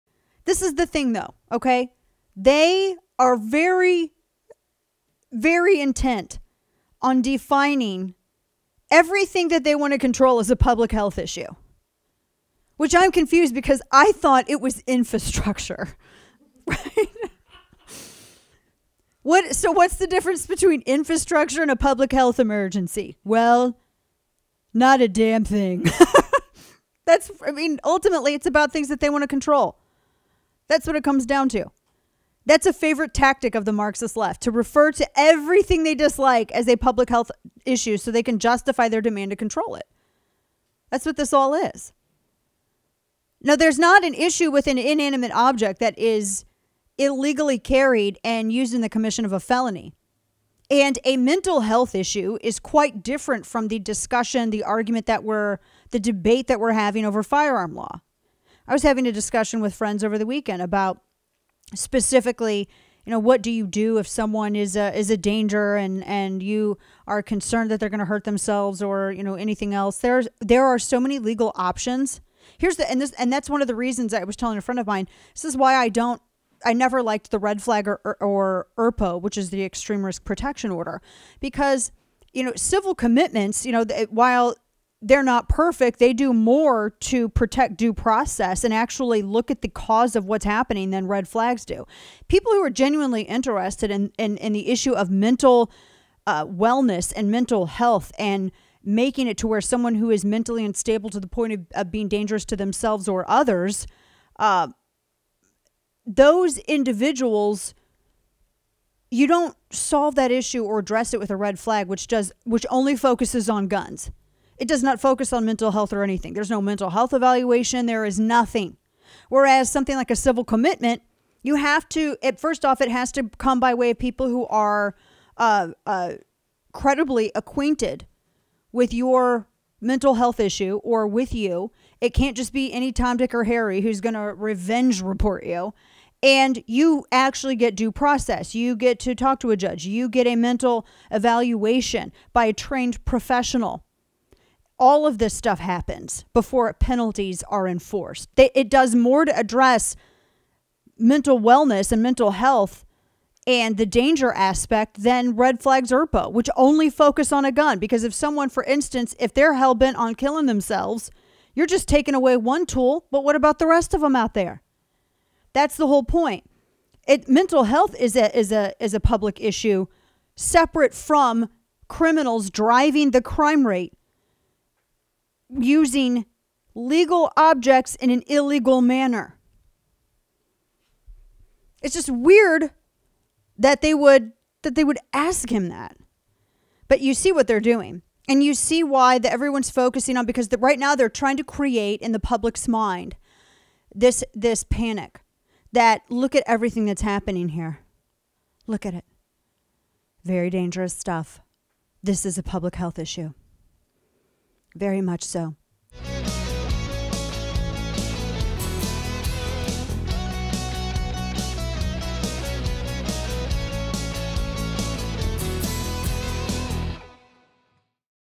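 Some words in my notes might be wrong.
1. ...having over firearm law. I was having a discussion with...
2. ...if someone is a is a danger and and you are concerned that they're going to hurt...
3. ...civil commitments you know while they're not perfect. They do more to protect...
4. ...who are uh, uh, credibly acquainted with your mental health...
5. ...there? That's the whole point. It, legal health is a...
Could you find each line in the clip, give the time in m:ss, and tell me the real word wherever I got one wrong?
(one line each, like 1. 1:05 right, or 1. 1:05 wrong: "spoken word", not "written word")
1. 0:56 right
2. 1:03 right
3. 1:22 right
4. 2:04 right
5. 2:44 wrong: "mental", not "legal".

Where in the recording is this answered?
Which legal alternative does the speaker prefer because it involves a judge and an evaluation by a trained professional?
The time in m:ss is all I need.
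2:00.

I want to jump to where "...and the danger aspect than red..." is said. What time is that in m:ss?
2:33.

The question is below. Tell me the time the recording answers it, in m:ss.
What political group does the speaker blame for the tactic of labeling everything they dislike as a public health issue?
0:33.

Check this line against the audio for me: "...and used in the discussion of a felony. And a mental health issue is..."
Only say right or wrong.
wrong.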